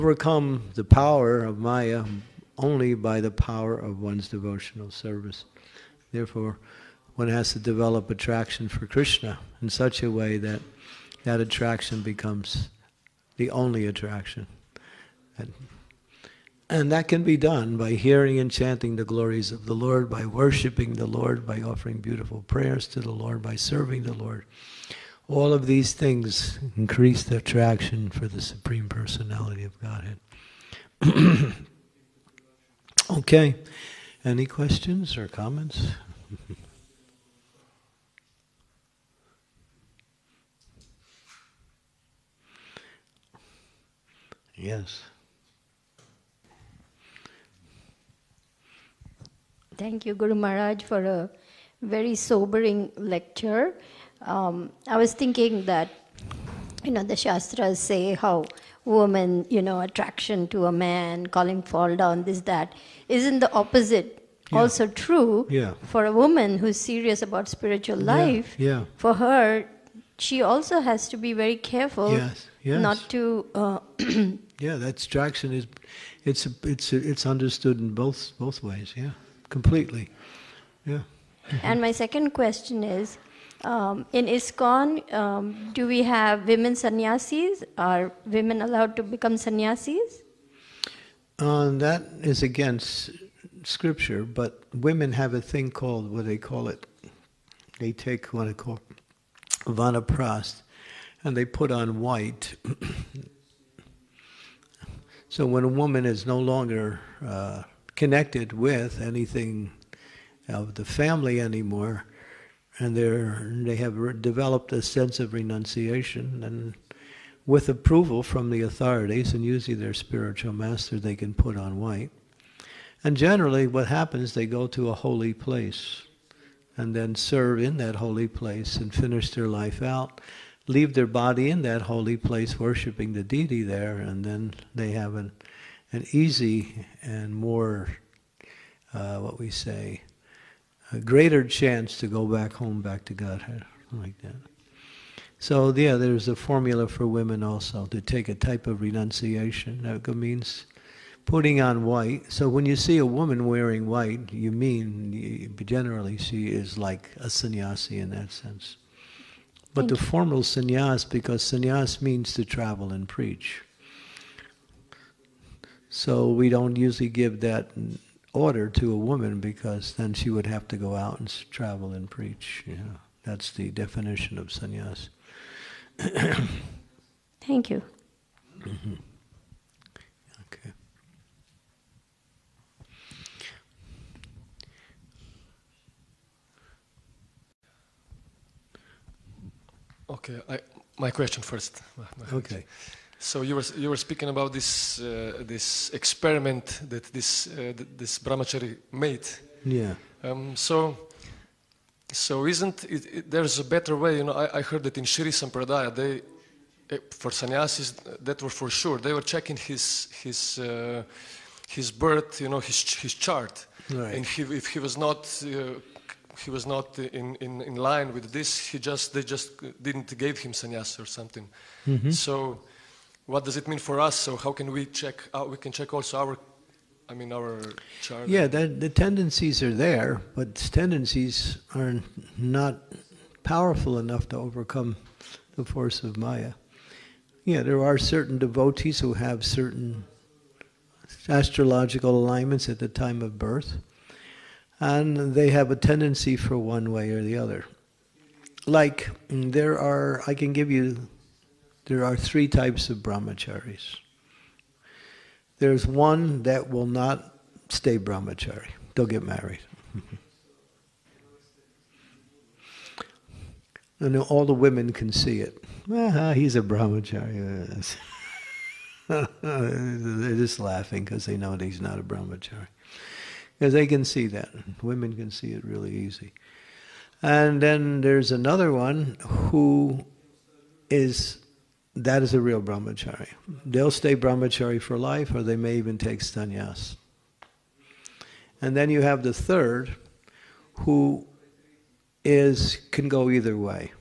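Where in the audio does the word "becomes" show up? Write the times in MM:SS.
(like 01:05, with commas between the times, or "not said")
00:12, 01:29.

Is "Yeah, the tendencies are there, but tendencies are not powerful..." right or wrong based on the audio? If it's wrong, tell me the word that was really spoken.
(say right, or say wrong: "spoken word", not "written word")
right.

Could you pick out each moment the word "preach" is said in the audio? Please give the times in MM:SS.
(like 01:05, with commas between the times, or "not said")
02:43, 02:52.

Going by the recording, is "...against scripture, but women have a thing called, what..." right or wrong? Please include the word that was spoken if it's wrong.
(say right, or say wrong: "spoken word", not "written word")
right.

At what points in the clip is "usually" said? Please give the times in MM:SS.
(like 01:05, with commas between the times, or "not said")
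01:59, 02:46.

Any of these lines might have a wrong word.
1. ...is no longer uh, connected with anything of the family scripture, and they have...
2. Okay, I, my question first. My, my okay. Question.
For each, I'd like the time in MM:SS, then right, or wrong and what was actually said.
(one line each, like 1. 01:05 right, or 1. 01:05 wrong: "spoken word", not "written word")
1. 01:46 wrong: "anymore", not "scripture"
2. 03:10 right.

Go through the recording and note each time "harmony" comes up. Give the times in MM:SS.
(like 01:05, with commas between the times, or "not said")
not said.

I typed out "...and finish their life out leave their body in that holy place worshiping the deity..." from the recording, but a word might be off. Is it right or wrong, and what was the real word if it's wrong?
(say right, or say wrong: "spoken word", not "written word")
right.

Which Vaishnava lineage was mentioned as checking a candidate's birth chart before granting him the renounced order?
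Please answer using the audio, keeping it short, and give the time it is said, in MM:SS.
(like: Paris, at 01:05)
Shri Sampradaya, at 03:25.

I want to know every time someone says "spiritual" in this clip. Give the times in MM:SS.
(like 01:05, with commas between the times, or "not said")
01:07, 01:59.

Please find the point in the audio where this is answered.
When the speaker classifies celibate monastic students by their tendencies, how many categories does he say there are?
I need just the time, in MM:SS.
04:12.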